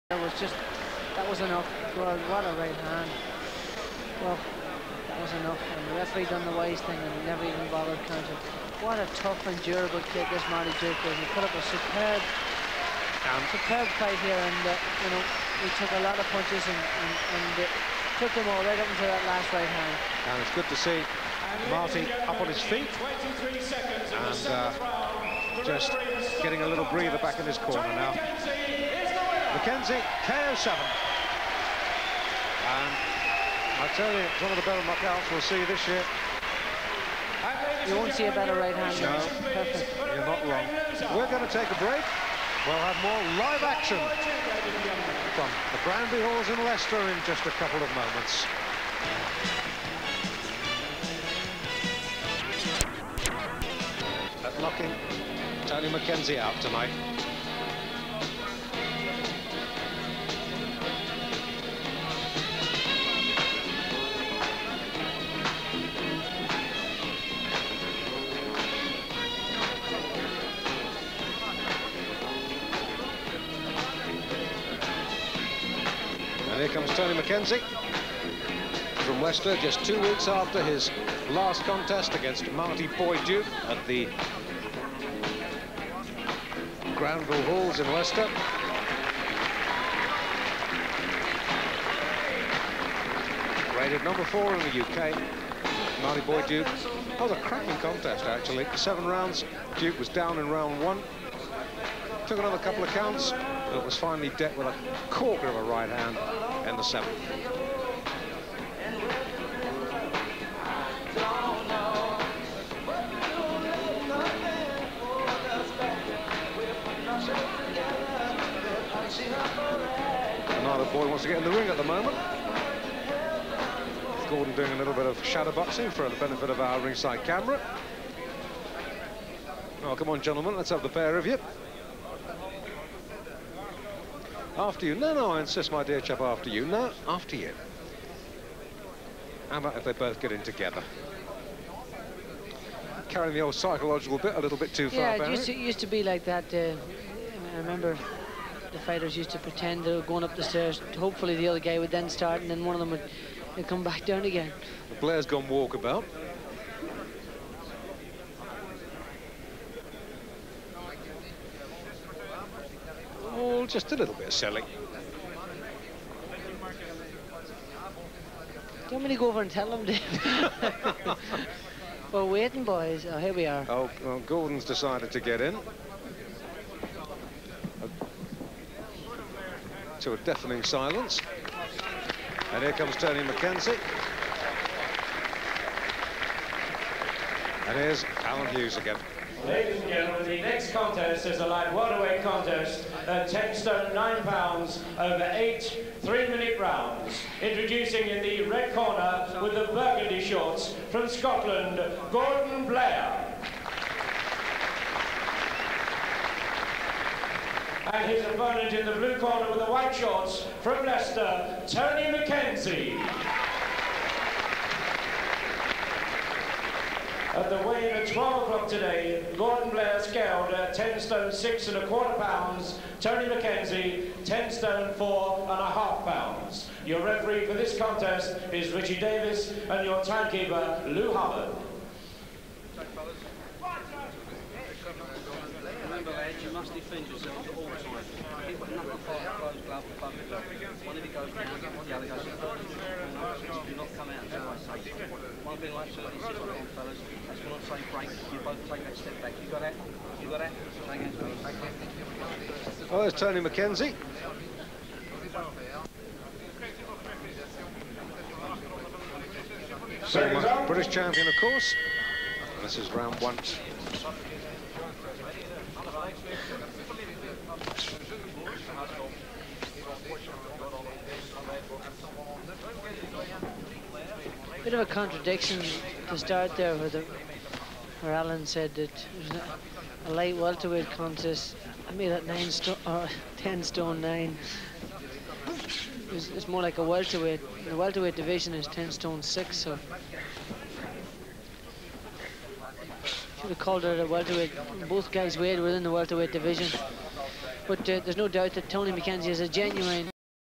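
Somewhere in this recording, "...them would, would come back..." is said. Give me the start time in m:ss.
2:32.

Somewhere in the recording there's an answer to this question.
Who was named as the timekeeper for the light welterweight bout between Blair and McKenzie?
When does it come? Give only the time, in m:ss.
3:50.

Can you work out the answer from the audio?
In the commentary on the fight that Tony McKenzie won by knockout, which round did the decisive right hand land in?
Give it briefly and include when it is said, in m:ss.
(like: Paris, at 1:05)
7, at 1:46.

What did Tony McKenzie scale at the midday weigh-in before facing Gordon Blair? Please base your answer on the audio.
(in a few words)
10 stone 4.5 pounds.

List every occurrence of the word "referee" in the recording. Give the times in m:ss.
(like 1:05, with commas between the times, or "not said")
0:06, 3:47.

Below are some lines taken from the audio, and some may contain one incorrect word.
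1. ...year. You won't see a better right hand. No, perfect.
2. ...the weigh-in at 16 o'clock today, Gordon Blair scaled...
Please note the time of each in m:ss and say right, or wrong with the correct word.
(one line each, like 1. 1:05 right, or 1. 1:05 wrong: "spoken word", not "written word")
1. 0:35 right
2. 3:37 wrong: "12", not "16".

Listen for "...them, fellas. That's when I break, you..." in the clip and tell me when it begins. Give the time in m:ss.
4:06.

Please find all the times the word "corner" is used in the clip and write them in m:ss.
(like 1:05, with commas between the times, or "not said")
0:27, 3:18, 3:29.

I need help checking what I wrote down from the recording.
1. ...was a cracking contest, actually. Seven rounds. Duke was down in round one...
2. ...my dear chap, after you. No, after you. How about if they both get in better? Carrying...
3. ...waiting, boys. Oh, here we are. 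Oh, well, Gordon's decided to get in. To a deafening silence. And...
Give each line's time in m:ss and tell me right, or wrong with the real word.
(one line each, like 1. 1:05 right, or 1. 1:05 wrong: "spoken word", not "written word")
1. 1:37 right
2. 2:15 wrong: "together", not "better"
3. 2:52 right.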